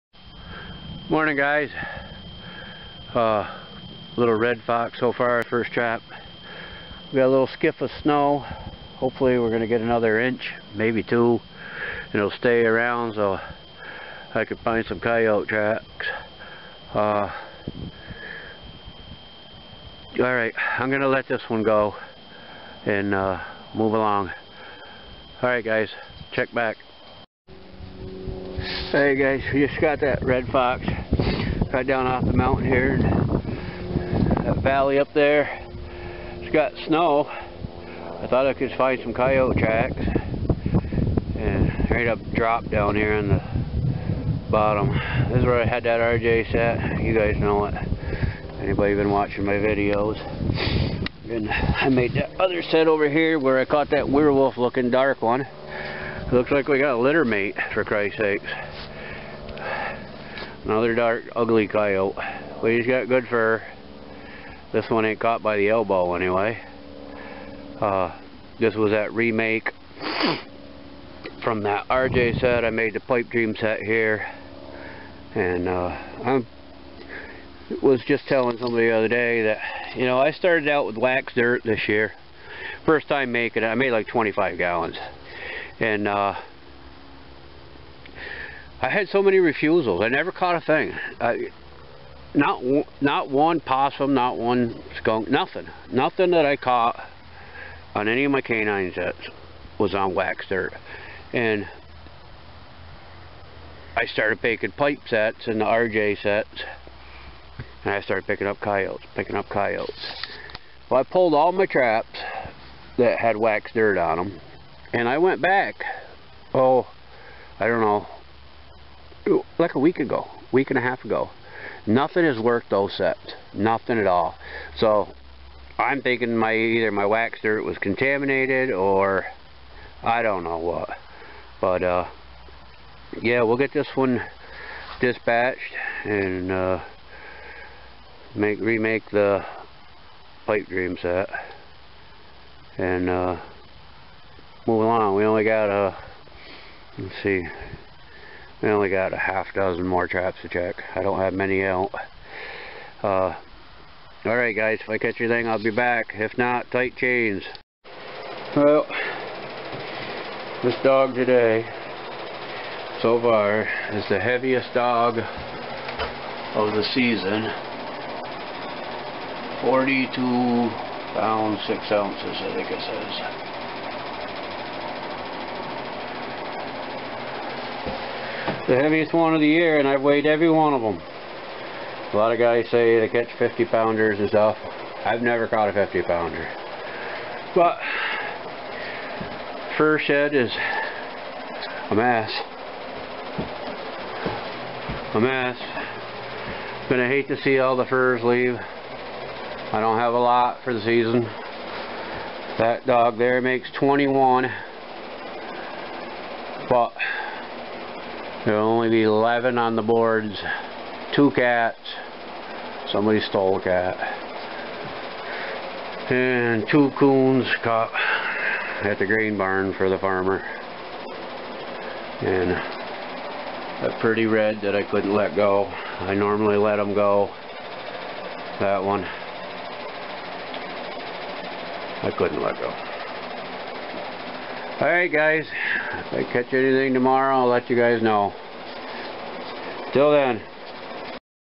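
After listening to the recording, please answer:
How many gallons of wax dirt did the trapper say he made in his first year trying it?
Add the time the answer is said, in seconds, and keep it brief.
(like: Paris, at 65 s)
25, at 84 s.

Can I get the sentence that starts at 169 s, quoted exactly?
42 pounds, 6 ounces I think it says.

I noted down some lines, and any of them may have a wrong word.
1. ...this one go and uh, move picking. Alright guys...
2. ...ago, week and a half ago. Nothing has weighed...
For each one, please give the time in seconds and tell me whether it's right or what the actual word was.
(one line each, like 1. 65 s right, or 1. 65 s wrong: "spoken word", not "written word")
1. 21 s wrong: "along", not "picking"
2. 119 s wrong: "worked", not "weighed".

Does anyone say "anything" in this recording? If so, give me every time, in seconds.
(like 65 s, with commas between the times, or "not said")
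155 s, 236 s.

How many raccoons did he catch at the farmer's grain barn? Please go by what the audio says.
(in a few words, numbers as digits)
2.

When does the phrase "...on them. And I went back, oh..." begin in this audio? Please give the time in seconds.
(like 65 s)
113 s.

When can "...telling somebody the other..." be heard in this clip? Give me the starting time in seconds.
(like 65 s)
78 s.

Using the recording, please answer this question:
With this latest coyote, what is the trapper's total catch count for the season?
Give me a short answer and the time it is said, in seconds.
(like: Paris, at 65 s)
21, at 203 s.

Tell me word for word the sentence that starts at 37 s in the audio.
I thought I could find some coyote tracks.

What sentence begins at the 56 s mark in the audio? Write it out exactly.
Looks like we got a litter mate, for Christ's sakes.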